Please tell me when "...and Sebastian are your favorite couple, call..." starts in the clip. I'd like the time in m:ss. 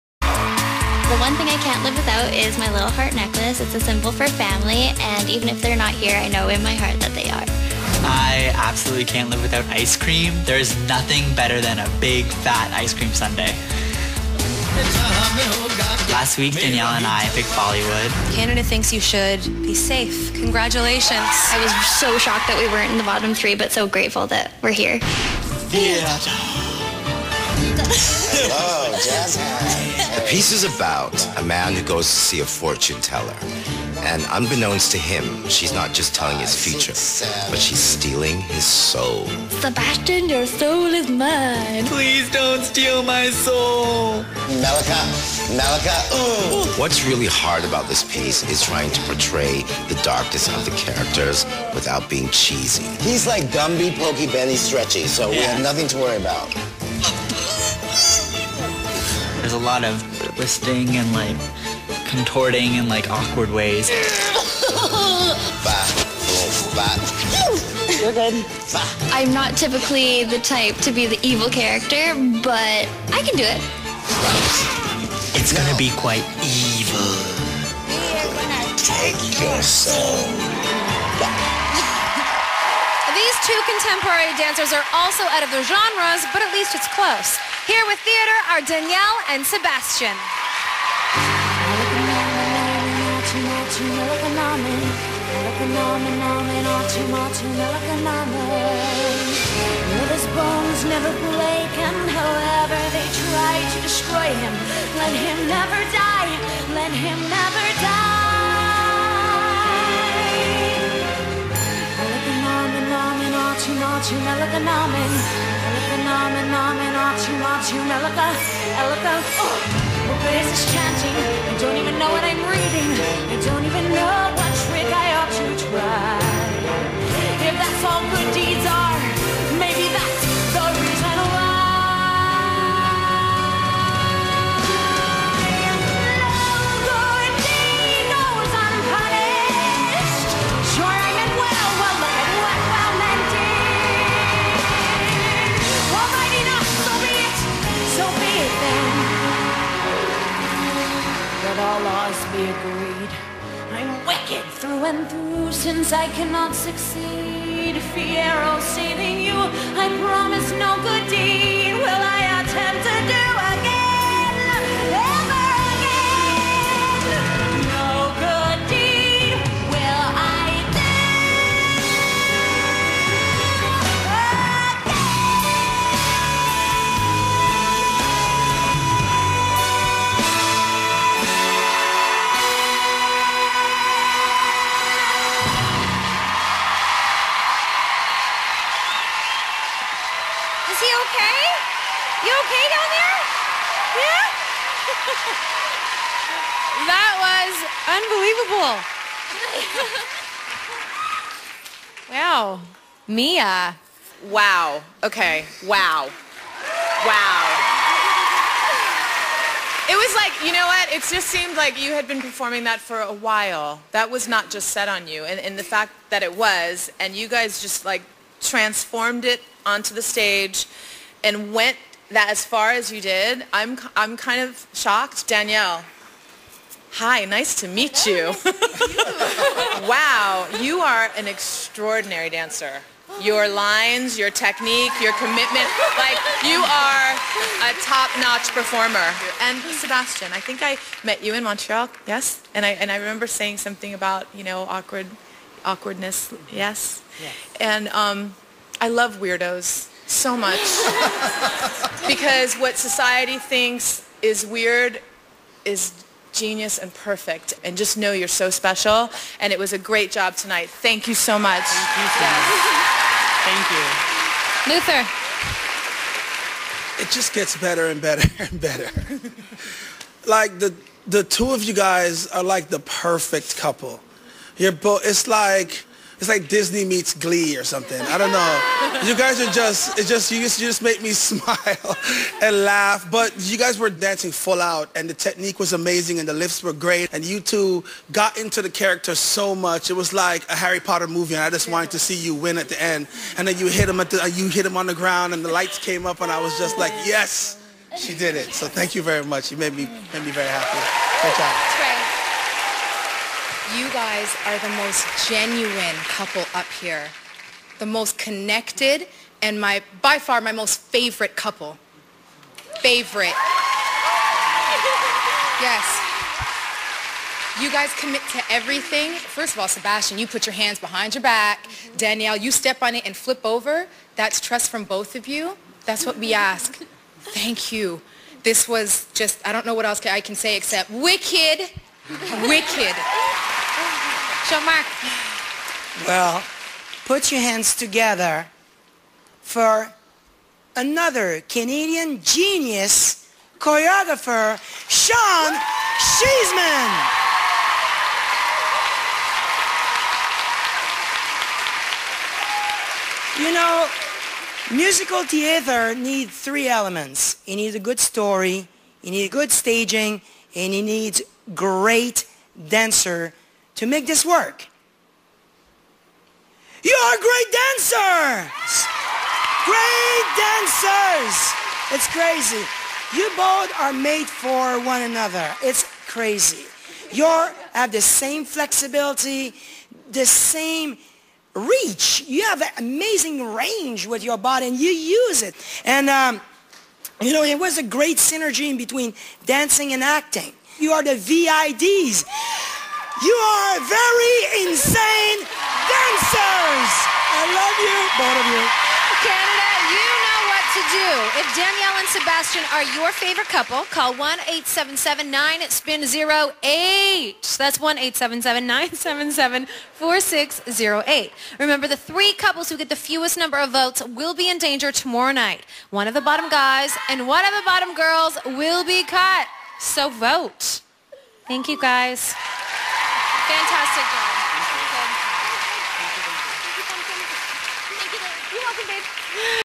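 6:41.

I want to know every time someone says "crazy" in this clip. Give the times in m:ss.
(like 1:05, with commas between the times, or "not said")
6:12, 6:16.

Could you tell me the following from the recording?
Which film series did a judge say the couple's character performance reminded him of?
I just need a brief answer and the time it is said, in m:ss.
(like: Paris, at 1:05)
Harry Potter, at 4:50.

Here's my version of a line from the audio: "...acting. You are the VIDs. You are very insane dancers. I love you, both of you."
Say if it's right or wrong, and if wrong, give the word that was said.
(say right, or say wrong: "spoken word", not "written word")
right.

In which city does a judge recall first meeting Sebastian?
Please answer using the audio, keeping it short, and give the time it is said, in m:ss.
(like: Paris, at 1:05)
Montreal, at 4:01.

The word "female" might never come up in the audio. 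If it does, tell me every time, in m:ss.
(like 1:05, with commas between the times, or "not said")
not said.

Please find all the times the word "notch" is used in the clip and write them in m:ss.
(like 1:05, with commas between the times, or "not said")
3:57.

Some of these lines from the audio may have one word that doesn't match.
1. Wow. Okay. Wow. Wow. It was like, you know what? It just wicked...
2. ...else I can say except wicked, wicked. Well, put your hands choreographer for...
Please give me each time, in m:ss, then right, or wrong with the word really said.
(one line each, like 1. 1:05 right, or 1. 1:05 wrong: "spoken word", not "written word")
1. 3:24 wrong: "seemed", not "wicked"
2. 5:29 wrong: "together", not "choreographer".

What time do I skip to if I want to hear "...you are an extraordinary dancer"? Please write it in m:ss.
3:50.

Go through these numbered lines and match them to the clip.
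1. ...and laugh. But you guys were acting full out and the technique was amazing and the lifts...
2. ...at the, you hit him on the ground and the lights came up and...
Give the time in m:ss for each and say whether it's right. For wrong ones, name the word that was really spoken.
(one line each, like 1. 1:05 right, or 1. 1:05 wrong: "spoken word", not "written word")
1. 4:42 wrong: "dancing", not "acting"
2. 4:53 right.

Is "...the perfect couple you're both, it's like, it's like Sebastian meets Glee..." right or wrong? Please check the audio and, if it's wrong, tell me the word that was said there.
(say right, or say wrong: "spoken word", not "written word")
wrong: "Disney", not "Sebastian".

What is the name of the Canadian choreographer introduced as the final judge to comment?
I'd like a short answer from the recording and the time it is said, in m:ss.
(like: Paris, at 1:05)
Sean Sheesman, at 5:44.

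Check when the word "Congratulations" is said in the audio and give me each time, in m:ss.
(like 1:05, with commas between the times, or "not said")
0:20.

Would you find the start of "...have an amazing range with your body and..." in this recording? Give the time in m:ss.
6:22.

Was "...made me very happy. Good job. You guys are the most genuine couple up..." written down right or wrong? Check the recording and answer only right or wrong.
right.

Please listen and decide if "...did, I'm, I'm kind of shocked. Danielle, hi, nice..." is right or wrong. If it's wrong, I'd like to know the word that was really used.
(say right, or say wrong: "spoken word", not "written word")
right.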